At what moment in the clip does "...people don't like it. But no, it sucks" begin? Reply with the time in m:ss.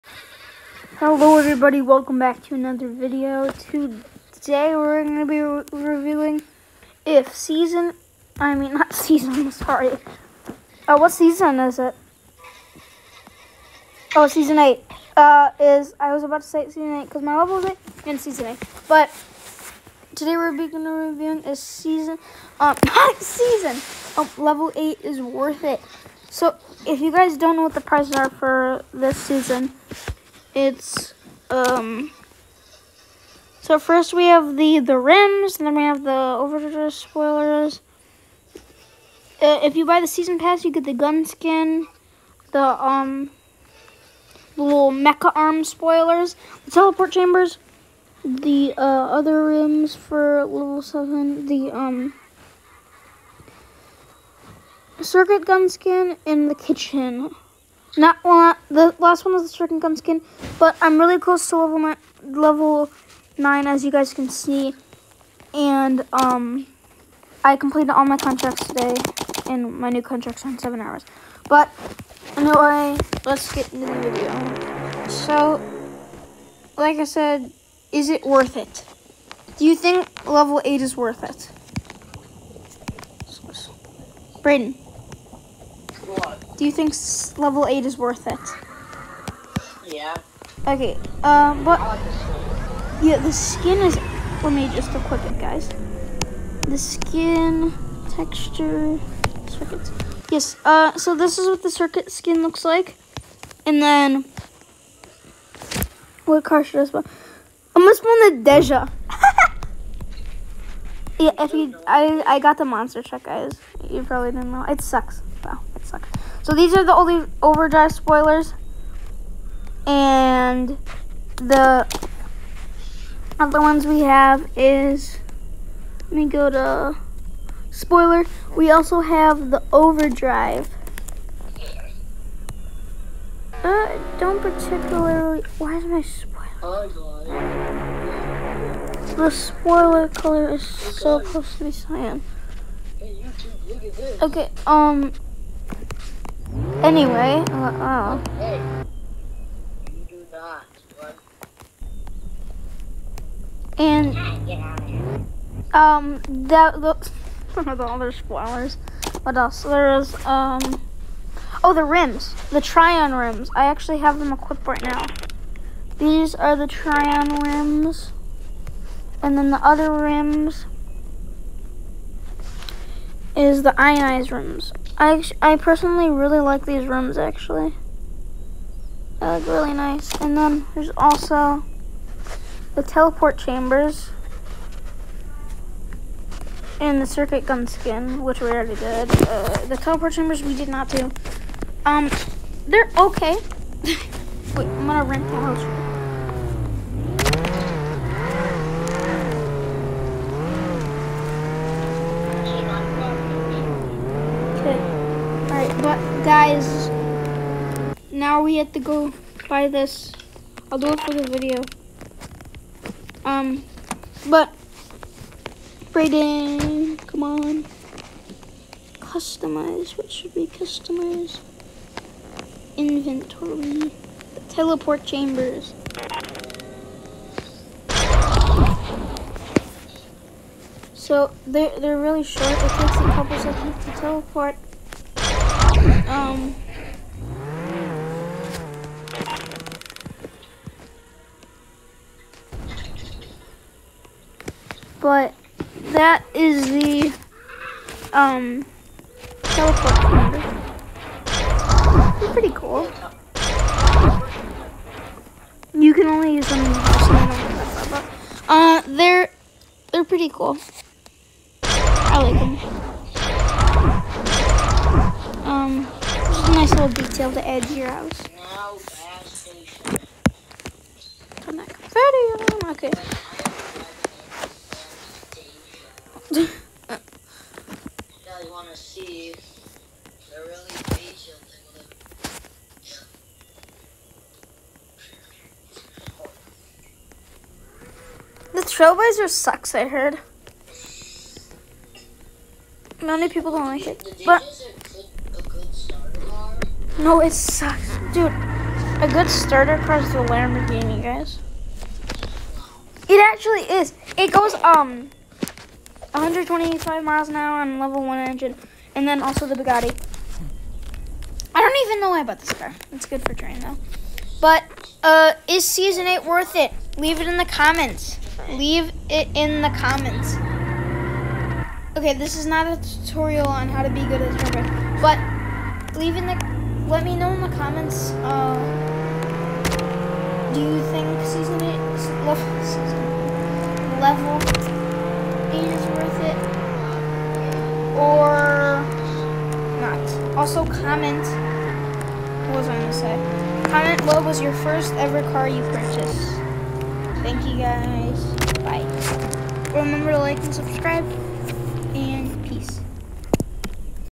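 4:53.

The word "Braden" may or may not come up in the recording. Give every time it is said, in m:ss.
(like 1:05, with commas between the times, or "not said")
1:24, 3:35.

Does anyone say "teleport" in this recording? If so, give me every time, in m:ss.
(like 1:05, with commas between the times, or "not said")
0:46, 3:02, 3:09, 3:44, 3:54, 4:09.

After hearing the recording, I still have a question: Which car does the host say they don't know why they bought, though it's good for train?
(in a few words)
Bugatti.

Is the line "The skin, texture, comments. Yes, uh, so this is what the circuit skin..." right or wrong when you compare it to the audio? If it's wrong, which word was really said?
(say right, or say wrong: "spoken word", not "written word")
wrong: "circuits", not "comments".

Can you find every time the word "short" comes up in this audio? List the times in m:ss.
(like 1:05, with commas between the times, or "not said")
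3:52.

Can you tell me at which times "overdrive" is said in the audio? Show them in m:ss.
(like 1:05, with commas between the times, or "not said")
0:36, 1:57, 2:09.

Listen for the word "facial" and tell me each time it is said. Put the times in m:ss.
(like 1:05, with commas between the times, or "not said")
4:40.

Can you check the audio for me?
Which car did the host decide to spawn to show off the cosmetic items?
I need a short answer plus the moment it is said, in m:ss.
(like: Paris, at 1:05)
Deja, at 1:48.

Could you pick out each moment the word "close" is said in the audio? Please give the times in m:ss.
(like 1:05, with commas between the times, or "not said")
1:01, 2:21.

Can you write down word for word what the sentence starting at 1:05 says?
And um, I completed all my contracts today, and my new contracts in seven hours.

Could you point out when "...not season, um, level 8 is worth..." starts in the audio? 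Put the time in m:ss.
0:22.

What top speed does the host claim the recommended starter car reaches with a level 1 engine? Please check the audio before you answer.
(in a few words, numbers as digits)
125 miles an hour.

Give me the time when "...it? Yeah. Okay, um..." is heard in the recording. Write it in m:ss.
1:28.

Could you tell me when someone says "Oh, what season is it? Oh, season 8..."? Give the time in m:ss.
0:10.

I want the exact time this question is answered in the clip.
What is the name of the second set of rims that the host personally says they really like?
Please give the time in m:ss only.
2:53.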